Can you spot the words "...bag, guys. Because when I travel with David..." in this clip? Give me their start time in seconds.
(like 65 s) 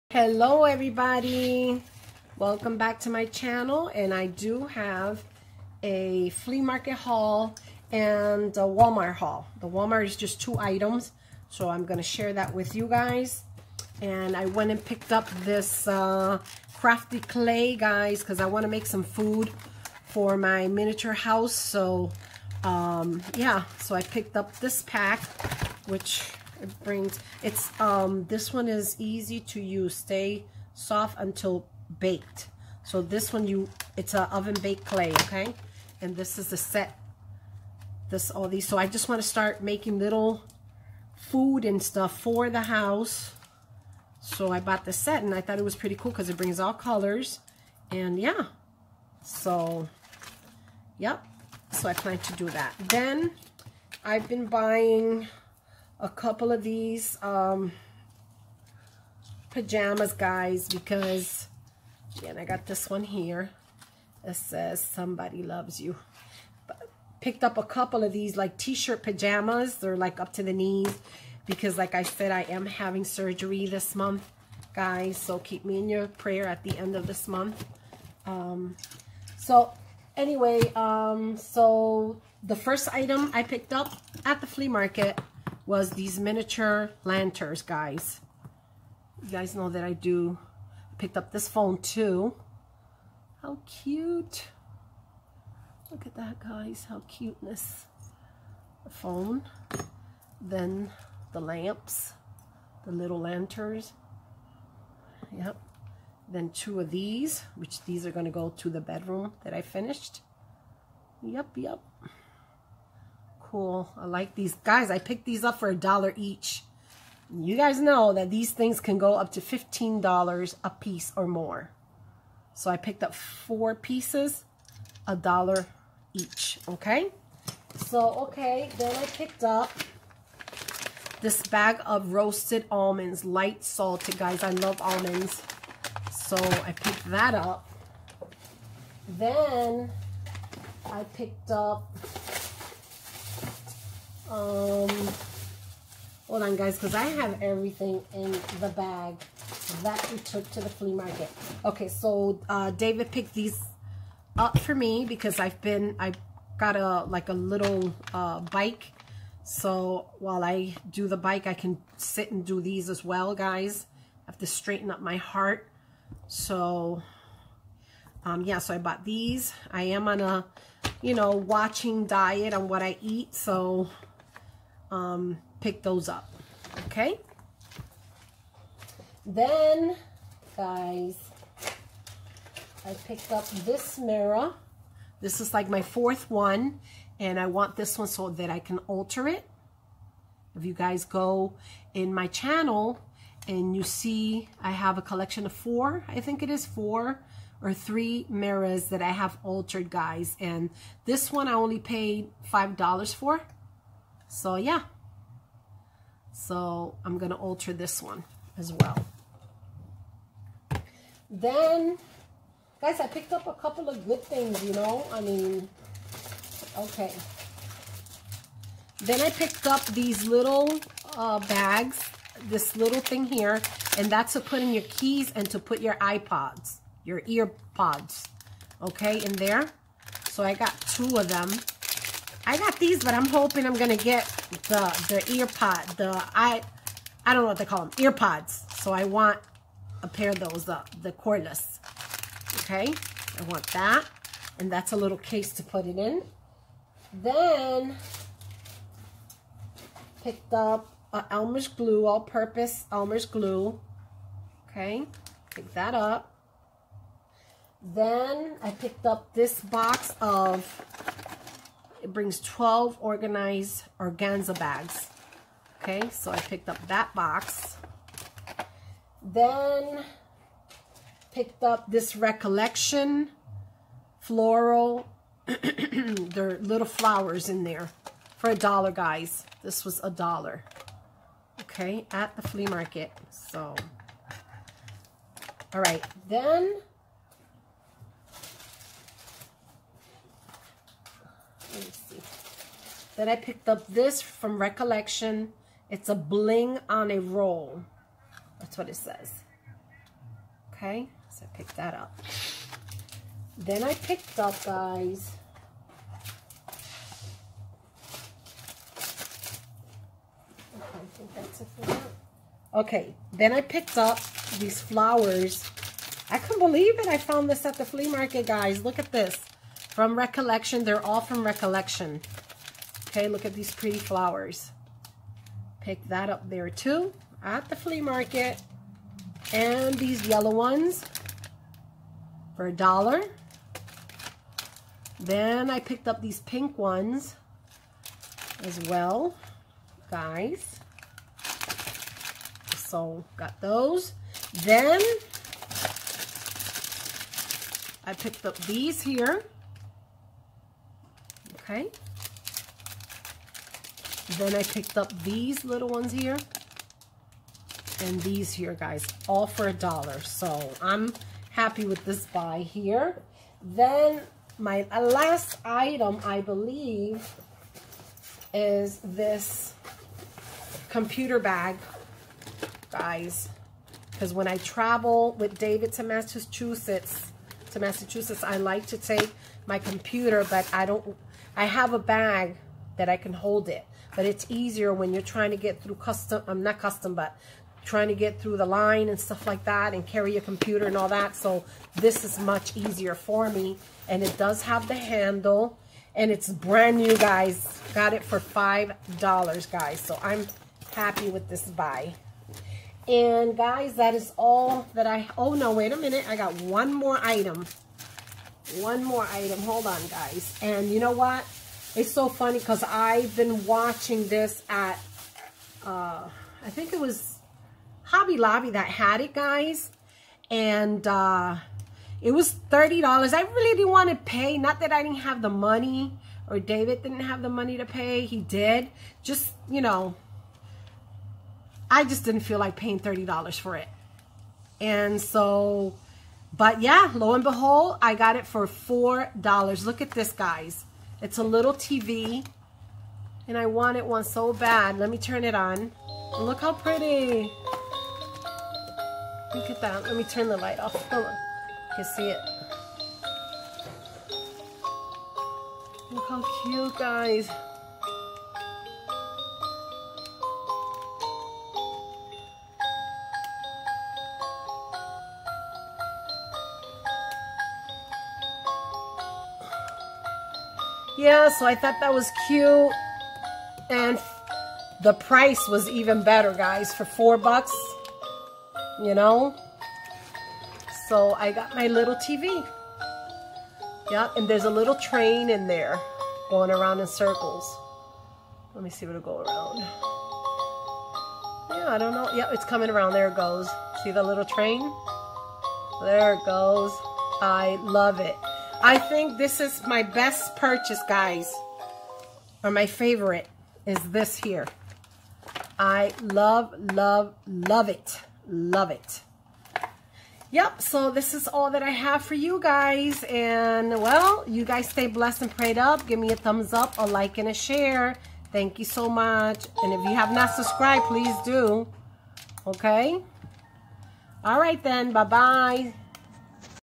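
371 s.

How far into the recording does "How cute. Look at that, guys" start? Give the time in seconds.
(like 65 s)
93 s.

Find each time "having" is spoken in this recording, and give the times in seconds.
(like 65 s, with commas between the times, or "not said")
72 s.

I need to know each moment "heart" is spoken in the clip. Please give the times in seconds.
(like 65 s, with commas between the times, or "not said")
165 s.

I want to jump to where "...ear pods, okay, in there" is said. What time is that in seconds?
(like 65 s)
227 s.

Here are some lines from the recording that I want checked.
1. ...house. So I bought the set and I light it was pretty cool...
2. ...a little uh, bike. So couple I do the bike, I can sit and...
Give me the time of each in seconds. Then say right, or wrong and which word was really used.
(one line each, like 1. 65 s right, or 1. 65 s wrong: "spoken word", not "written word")
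1. 42 s wrong: "thought", not "light"
2. 157 s wrong: "while", not "couple".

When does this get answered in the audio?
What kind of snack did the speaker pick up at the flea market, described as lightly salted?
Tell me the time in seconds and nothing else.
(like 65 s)
132 s.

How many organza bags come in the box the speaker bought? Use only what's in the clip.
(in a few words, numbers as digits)
12.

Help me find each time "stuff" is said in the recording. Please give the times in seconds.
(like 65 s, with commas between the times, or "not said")
41 s, 389 s.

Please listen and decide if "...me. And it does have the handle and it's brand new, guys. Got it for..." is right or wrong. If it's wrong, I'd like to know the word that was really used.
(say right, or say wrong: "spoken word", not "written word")
right.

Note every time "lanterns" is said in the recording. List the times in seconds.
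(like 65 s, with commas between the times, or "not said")
87 s, 103 s.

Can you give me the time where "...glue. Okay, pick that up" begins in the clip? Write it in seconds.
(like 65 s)
253 s.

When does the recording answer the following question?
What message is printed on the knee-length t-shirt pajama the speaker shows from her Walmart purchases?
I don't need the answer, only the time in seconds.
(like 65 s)
64 s.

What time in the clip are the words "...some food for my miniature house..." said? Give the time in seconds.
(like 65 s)
18 s.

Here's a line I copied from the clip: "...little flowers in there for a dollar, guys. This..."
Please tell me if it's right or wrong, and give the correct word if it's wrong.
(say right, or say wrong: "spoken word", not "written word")
right.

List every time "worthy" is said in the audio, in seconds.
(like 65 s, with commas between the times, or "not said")
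not said.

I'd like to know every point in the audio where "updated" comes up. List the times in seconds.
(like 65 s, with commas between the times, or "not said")
not said.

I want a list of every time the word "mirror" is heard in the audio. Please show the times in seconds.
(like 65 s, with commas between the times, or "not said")
183 s, 198 s.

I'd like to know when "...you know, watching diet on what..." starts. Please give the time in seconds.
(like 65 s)
171 s.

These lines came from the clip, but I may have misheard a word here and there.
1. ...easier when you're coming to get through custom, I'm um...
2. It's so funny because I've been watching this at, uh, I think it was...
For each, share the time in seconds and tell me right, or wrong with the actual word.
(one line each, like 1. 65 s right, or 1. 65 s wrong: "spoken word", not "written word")
1. 384 s wrong: "trying", not "coming"
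2. 411 s right.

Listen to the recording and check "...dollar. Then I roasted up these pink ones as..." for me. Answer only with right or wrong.
wrong.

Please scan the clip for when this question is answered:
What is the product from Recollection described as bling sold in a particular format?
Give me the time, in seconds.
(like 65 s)
296 s.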